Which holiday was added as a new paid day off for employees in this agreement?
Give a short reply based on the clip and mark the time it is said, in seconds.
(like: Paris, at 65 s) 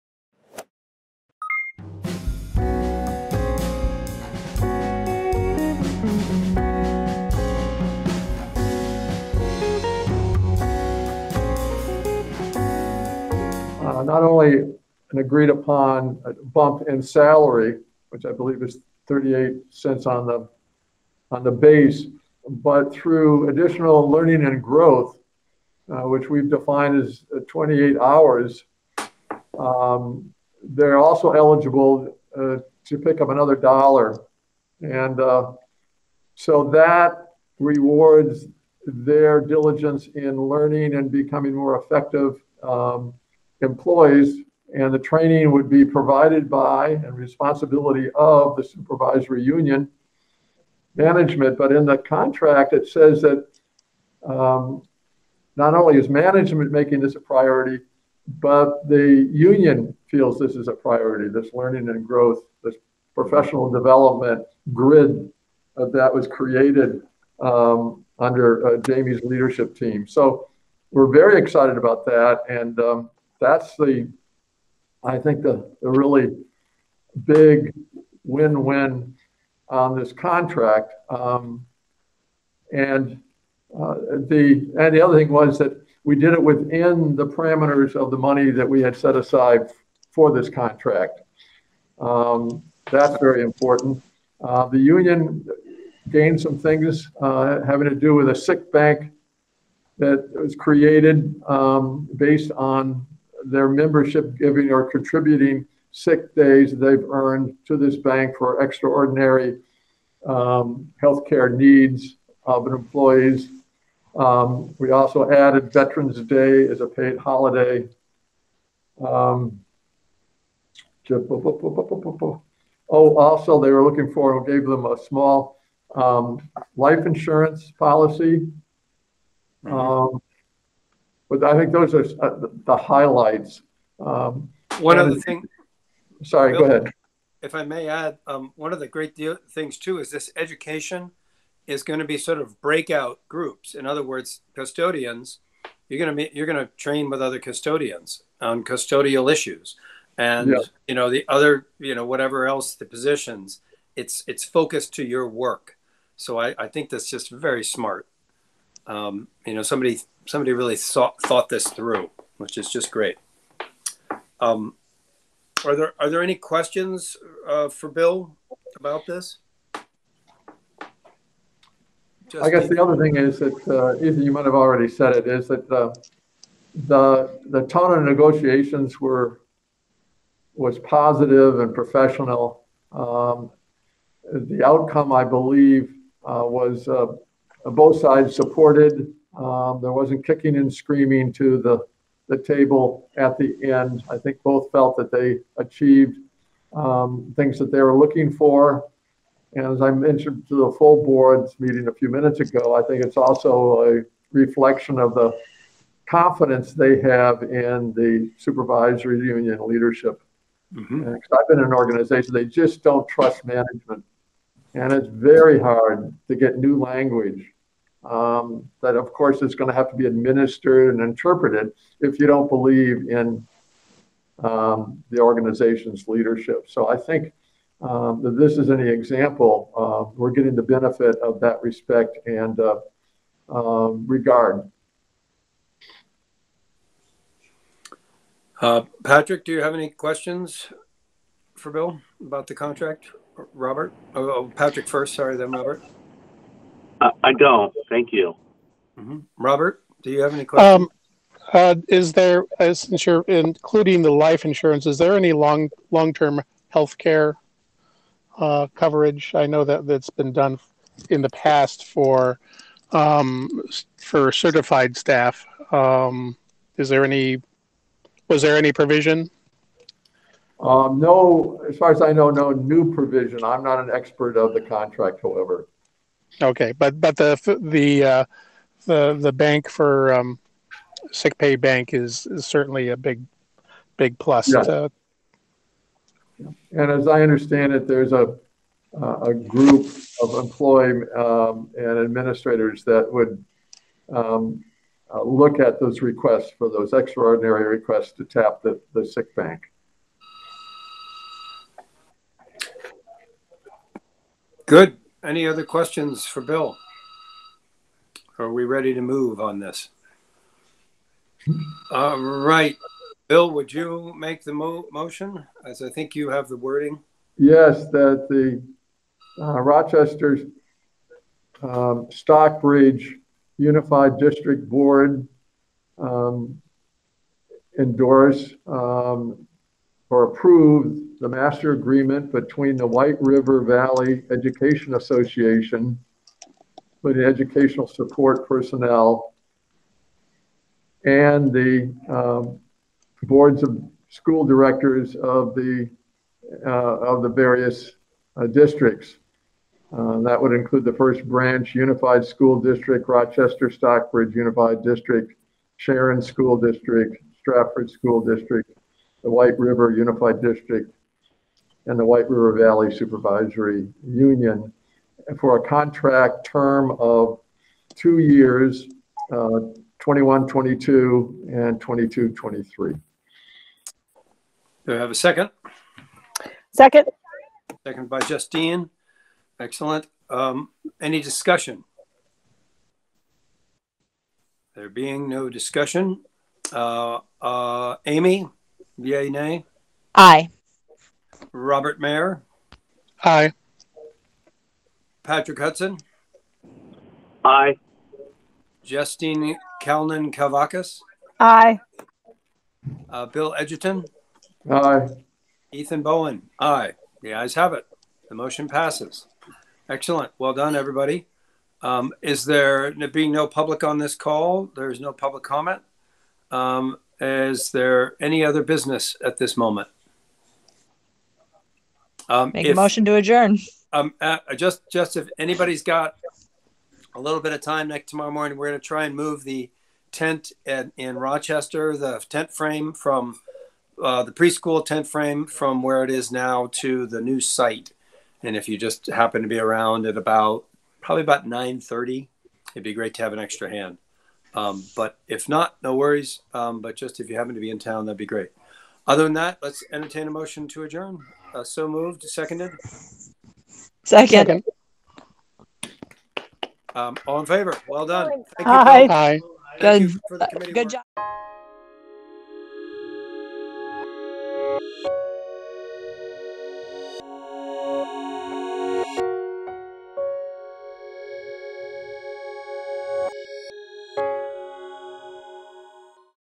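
Veterans Day, at 115 s.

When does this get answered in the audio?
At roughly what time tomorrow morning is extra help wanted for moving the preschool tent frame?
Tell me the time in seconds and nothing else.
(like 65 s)
441 s.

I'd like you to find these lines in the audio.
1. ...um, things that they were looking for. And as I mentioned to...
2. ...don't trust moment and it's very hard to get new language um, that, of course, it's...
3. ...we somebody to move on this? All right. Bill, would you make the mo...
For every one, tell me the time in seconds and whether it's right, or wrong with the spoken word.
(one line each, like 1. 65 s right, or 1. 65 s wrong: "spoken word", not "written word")
1. 196 s right
2. 212 s wrong: "management", not "moment"
3. 308 s wrong: "ready", not "somebody".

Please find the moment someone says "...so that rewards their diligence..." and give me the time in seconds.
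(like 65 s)
36 s.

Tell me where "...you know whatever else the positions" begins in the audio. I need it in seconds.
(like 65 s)
151 s.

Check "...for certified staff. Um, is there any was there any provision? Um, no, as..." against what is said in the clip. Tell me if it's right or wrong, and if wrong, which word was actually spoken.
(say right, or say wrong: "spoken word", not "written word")
right.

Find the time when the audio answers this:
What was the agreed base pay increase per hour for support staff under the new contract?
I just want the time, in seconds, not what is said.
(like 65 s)
19 s.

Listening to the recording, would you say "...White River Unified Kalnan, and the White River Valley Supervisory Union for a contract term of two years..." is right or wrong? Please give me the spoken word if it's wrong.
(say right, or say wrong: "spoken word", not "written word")
wrong: "District", not "Kalnan".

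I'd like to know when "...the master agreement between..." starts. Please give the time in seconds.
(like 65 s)
331 s.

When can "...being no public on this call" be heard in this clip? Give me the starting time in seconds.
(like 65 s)
413 s.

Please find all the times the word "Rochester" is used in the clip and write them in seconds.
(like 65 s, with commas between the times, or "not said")
353 s, 431 s.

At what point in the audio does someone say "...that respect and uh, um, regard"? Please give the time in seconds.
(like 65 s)
231 s.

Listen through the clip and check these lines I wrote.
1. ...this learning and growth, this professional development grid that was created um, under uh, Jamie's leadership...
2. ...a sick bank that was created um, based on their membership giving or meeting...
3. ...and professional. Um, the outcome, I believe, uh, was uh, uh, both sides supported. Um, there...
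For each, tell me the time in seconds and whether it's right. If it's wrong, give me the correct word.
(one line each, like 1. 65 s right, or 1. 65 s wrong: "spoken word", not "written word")
1. 61 s right
2. 98 s wrong: "contributing", not "meeting"
3. 181 s right.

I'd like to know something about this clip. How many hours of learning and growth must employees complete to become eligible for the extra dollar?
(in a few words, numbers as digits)
28 hours.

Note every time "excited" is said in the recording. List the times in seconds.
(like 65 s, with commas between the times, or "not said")
71 s.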